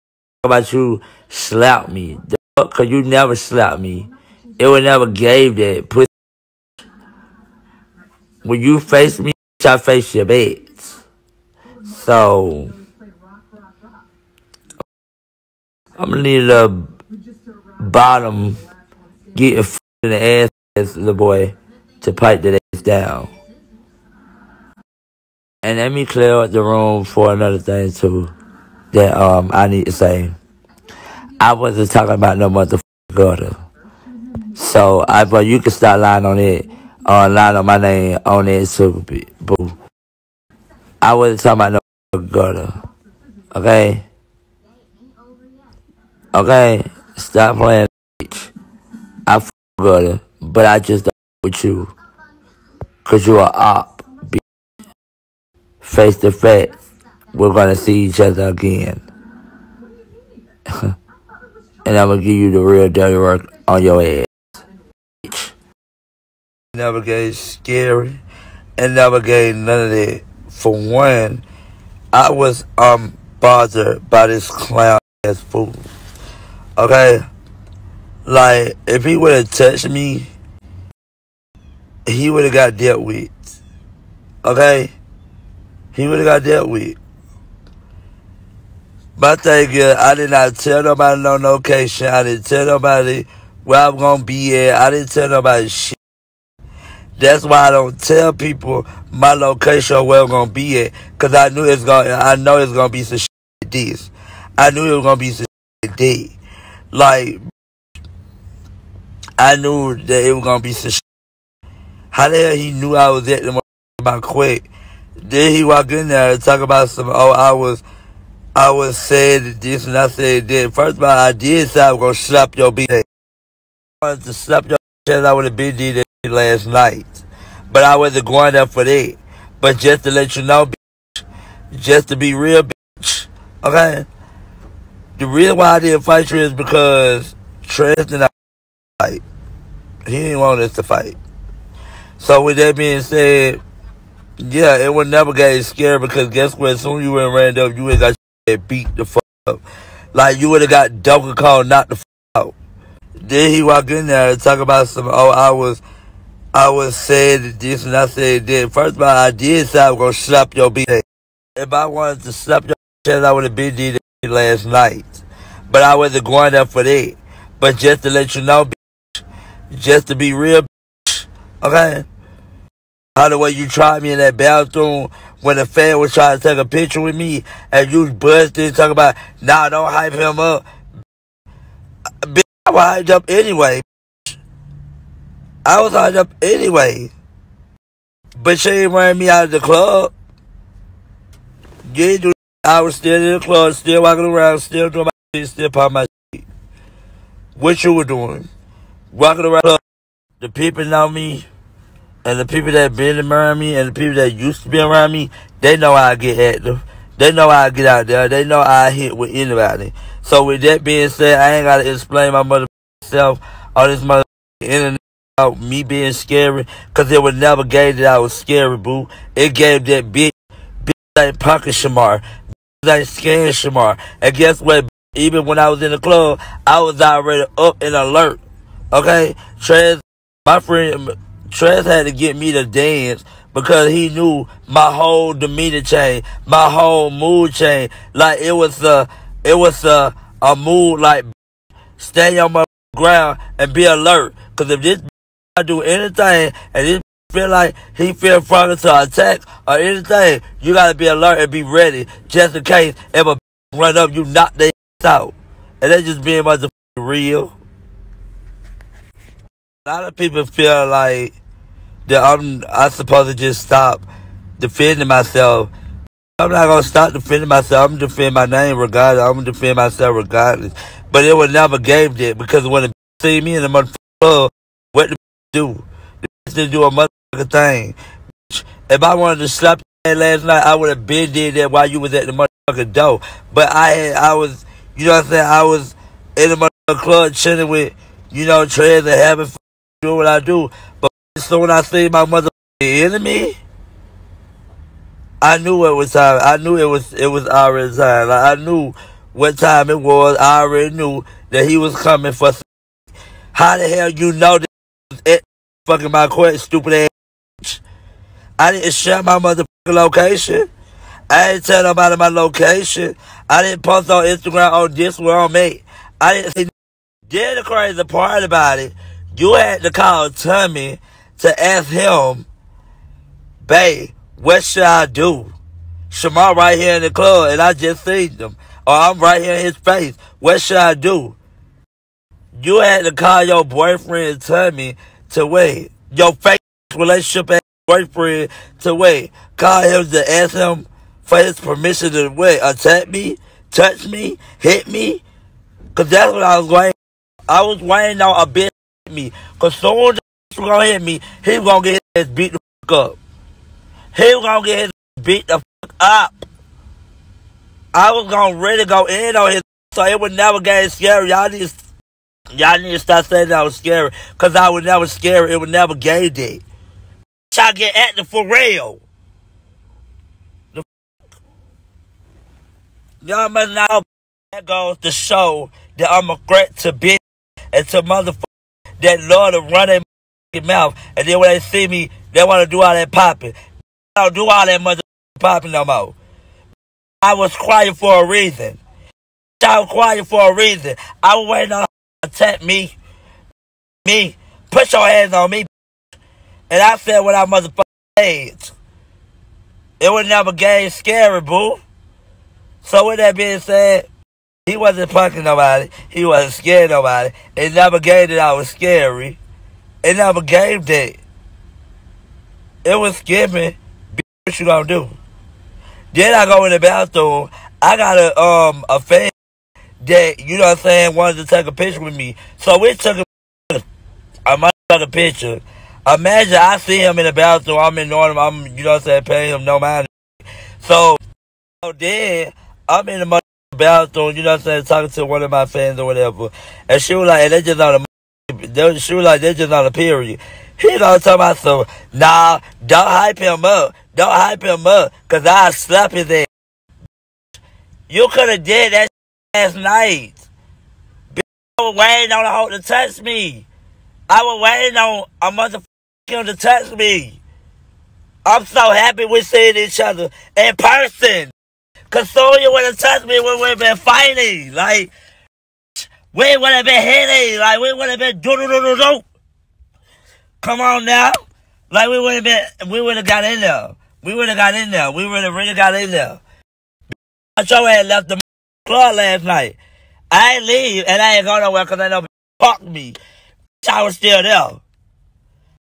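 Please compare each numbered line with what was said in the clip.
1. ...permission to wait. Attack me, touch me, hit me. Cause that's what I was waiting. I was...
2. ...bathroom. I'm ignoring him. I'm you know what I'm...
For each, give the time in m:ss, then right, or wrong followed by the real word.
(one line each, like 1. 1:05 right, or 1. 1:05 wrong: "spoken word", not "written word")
1. 5:41 right
2. 7:07 right.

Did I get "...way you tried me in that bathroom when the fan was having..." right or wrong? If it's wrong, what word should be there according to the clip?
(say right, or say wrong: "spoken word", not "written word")
wrong: "trying", not "having".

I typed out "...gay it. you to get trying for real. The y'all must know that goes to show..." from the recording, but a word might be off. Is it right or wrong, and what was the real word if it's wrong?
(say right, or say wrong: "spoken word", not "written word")
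wrong: "acting", not "trying".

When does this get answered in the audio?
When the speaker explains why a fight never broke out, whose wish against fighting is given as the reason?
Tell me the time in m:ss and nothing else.
2:17.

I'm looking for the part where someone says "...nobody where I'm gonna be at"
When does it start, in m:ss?
1:32.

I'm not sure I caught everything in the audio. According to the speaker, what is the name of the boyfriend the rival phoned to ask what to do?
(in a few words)
Tummy.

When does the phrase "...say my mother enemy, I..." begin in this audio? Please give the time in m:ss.
4:51.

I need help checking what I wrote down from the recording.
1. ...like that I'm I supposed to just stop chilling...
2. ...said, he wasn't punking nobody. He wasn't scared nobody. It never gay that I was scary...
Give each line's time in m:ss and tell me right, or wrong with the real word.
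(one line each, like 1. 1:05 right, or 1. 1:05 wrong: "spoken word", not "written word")
1. 4:20 wrong: "defending", not "chilling"
2. 6:43 right.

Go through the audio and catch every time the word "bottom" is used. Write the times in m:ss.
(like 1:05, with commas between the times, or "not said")
0:17.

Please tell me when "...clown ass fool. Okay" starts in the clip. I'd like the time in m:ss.
1:14.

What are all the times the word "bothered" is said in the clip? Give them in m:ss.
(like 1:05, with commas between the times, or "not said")
1:13.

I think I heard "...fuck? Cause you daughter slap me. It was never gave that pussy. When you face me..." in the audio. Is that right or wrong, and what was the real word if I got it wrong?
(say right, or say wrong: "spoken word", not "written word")
wrong: "never", not "daughter".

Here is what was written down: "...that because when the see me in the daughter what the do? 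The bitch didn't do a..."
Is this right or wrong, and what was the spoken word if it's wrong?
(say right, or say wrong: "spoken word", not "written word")
wrong: "motherfucker", not "daughter".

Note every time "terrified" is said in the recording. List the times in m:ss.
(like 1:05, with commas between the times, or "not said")
not said.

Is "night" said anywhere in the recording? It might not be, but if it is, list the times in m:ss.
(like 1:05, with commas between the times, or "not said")
2:06, 2:44, 4:40, 7:29, 7:59.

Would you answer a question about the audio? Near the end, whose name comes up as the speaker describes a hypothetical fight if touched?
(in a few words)
Sonya.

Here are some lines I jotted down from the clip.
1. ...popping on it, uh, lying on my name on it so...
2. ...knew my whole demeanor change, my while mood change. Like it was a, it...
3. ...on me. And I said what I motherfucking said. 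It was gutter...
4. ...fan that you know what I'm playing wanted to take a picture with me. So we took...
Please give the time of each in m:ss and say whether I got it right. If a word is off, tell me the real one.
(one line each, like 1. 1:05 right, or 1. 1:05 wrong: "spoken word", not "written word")
1. 0:36 wrong: "lying", not "popping"
2. 3:54 wrong: "whole", not "while"
3. 6:35 wrong: "never", not "gutter"
4. 6:58 wrong: "saying", not "playing".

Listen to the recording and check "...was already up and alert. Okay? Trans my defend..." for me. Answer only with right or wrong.
wrong.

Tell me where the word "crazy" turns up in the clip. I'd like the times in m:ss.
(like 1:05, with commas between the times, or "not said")
5:17.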